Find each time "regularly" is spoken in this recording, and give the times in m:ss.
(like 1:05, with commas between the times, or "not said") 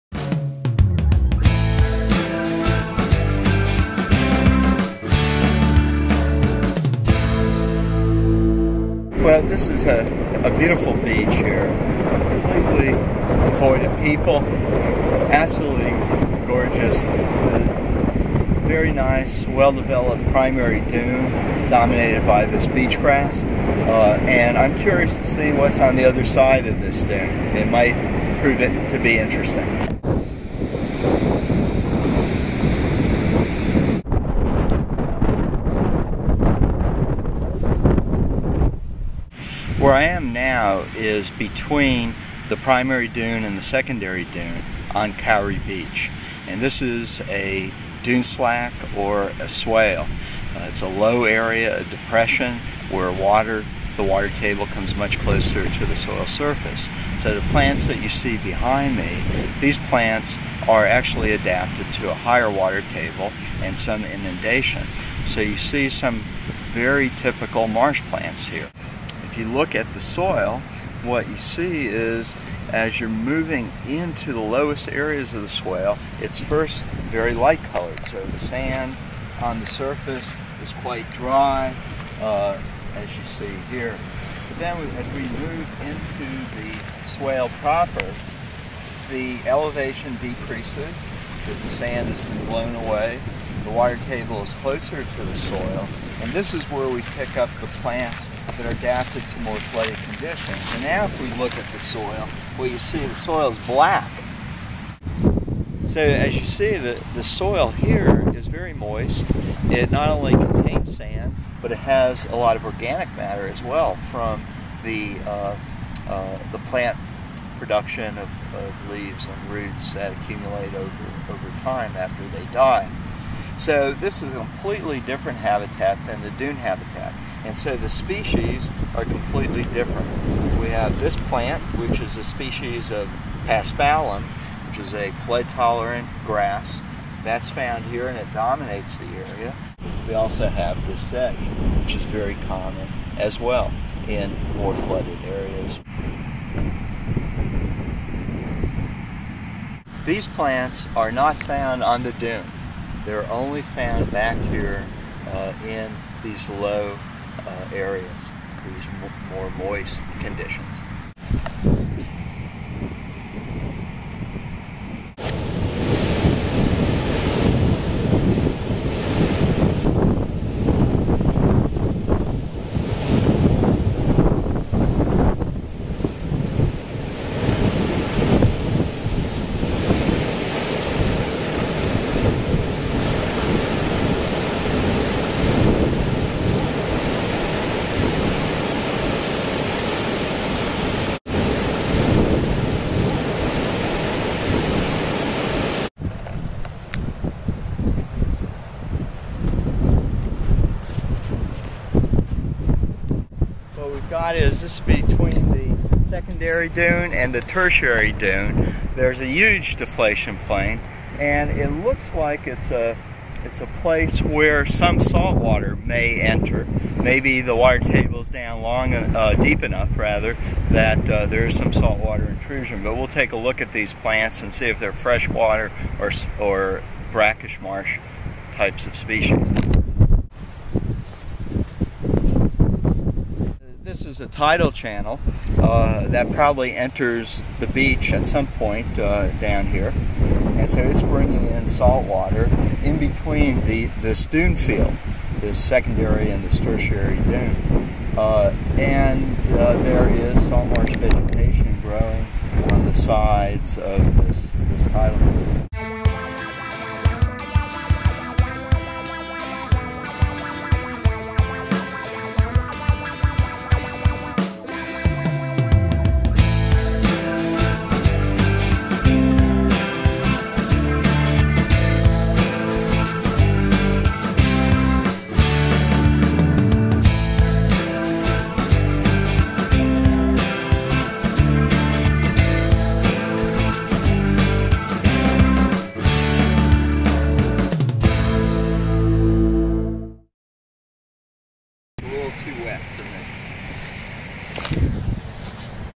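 not said.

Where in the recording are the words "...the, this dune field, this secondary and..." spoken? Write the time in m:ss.
4:03.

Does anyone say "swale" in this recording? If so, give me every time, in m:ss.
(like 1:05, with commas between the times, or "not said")
0:49, 1:15, 1:27.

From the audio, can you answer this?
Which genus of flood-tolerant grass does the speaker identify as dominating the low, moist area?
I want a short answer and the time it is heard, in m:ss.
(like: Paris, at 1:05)
Paspalum, at 2:13.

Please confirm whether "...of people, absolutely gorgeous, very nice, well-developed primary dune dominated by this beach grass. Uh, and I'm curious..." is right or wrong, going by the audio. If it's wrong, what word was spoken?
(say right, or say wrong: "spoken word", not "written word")
right.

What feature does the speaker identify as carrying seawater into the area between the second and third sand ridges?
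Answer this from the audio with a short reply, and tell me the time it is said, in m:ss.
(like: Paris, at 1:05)
A tidal channel, at 3:54.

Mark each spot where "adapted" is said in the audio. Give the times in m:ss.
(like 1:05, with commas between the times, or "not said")
1:01, 1:38.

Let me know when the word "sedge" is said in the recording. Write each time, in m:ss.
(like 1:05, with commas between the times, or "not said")
2:20.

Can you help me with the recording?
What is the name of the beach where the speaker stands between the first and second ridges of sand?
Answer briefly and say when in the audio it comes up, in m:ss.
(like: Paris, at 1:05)
Kauri Beach, at 0:45.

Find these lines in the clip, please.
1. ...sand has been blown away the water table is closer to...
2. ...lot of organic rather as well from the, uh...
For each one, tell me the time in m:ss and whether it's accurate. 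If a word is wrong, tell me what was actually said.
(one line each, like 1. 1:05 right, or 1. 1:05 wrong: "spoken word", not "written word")
1. 1:31 right
2. 1:52 wrong: "matter", not "rather".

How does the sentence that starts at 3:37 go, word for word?
Maybe the water table is down long, uh, deep enough rather, that uh, there is some saltwater intrusion.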